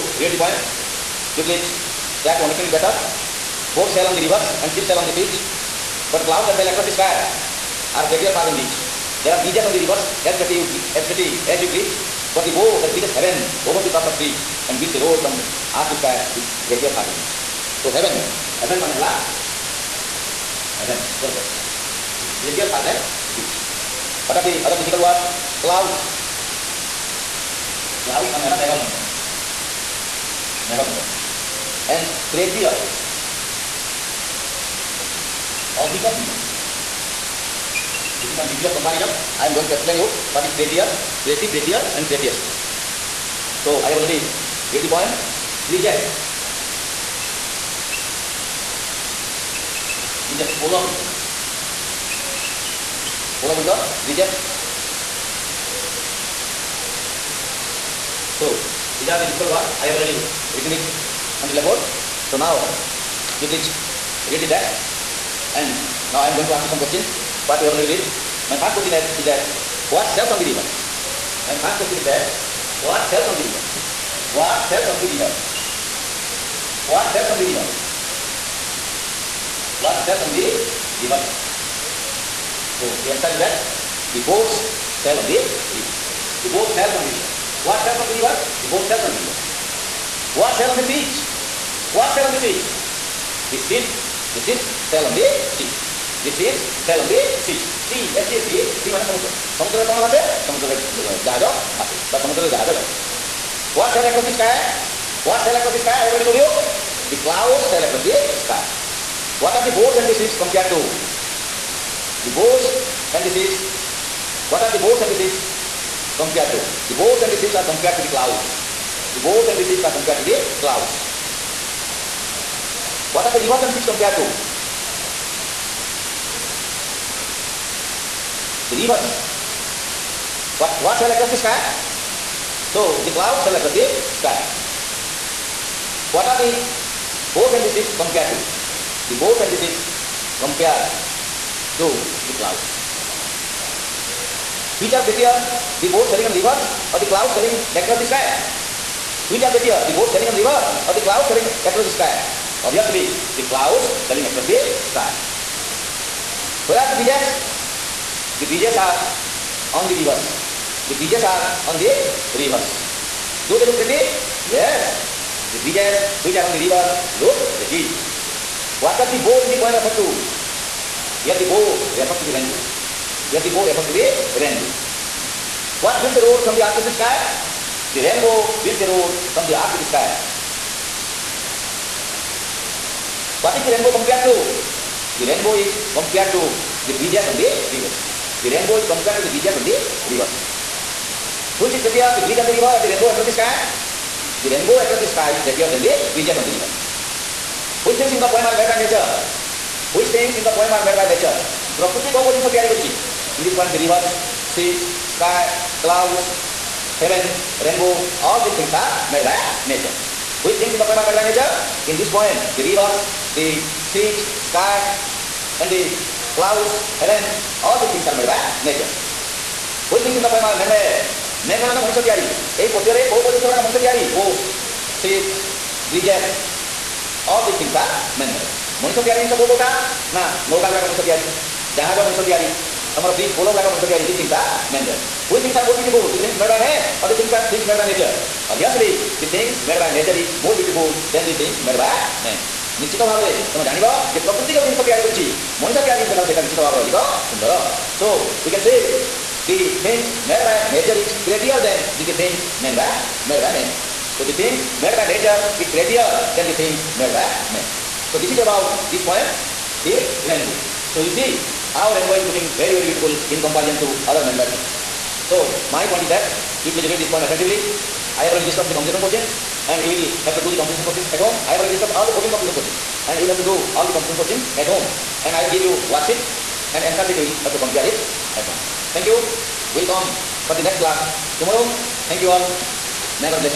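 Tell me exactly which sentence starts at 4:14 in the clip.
So the things made by nature is prettier than the things made by man.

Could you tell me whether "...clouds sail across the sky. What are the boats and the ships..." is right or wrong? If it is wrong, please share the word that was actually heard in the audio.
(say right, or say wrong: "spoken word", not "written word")
right.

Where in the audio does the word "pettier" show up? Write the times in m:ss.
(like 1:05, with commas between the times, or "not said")
2:29.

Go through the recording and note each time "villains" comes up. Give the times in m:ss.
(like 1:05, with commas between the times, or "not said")
not said.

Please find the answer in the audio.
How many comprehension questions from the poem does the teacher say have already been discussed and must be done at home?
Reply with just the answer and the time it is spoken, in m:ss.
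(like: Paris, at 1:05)
14, at 4:32.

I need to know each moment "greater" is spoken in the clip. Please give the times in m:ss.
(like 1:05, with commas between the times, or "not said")
0:16, 0:22.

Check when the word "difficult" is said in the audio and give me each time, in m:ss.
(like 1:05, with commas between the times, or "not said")
0:24, 0:59.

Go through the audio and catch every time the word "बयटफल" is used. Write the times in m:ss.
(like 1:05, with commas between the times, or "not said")
3:55, 4:00.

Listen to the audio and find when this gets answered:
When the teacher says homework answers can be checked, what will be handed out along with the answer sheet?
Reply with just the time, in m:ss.
4:35.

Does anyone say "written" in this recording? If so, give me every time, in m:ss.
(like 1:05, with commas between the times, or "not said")
1:00.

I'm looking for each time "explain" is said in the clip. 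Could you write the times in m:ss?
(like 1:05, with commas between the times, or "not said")
0:39.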